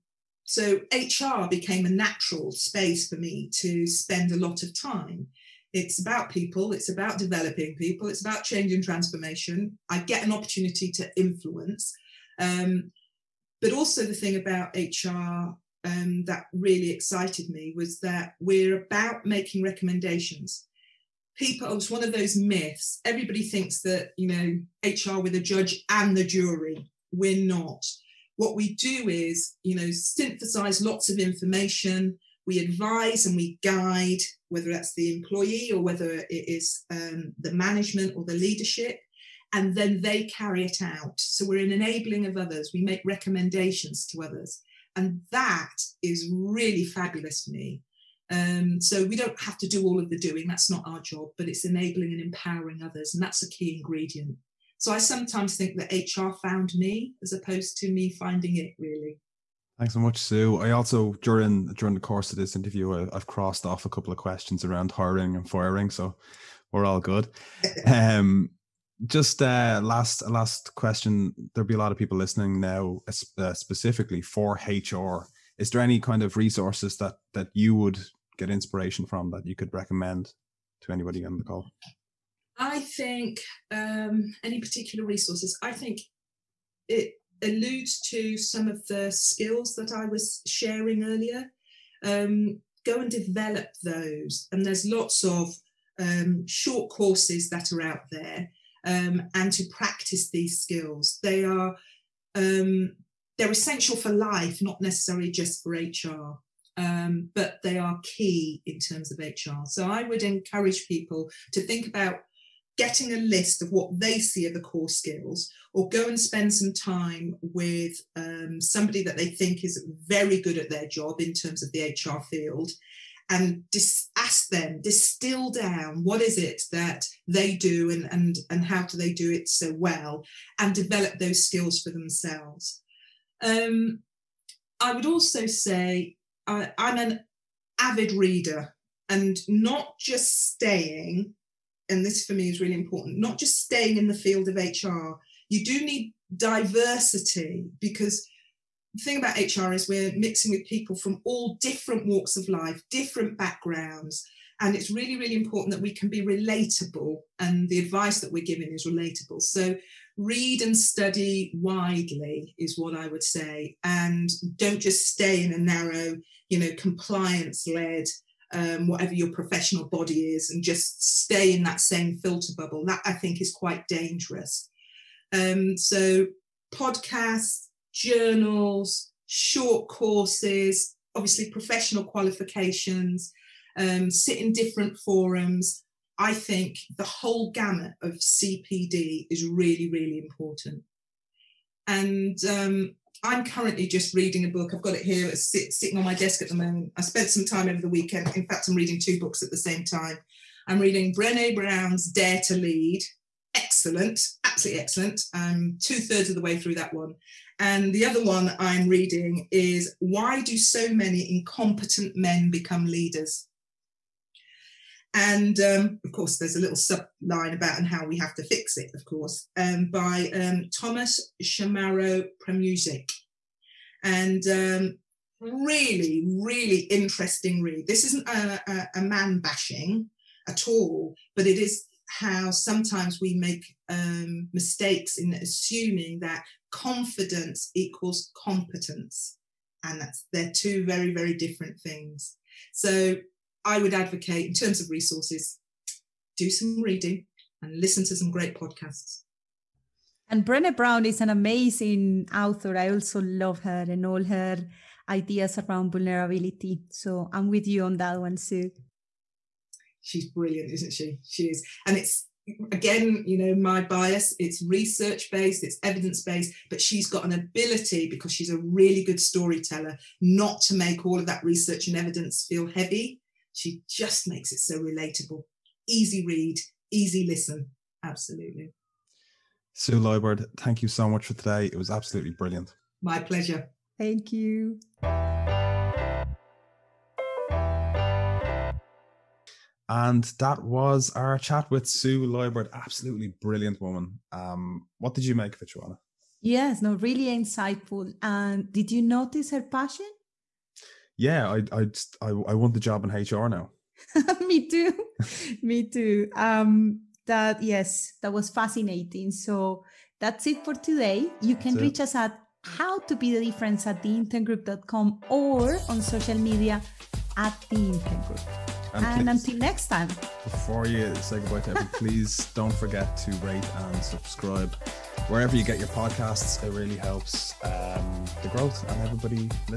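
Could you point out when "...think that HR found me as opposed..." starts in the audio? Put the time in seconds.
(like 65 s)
55 s.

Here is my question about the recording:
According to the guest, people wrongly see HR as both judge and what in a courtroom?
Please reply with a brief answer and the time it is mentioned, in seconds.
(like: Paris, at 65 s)
the jury, at 26 s.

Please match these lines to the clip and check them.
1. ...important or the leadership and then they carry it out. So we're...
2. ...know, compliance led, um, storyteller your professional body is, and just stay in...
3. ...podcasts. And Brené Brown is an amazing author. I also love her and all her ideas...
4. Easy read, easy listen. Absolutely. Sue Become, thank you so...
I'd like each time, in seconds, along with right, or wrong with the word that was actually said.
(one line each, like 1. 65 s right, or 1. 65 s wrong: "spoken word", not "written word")
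1. 37 s wrong: "management", not "important"
2. 166 s wrong: "whatever", not "storyteller"
3. 248 s right
4. 275 s wrong: "Liburd", not "Become".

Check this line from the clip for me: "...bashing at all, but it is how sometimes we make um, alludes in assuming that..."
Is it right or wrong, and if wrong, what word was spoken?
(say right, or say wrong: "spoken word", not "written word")
wrong: "mistakes", not "alludes".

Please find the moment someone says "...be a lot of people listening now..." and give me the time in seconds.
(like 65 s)
71 s.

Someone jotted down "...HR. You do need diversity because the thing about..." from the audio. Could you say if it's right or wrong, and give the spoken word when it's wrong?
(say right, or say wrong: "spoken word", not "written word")
right.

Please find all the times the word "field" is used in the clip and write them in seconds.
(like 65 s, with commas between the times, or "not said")
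122 s, 144 s.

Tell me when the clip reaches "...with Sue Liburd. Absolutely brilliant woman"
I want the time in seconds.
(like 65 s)
291 s.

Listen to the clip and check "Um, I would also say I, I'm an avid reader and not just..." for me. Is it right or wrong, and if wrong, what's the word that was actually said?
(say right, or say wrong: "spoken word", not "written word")
right.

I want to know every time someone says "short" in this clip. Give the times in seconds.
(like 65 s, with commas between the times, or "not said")
96 s, 179 s.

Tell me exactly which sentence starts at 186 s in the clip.
I think the whole gamut of CPD is really, really important.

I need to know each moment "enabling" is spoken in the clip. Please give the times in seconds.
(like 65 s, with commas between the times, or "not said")
41 s, 51 s.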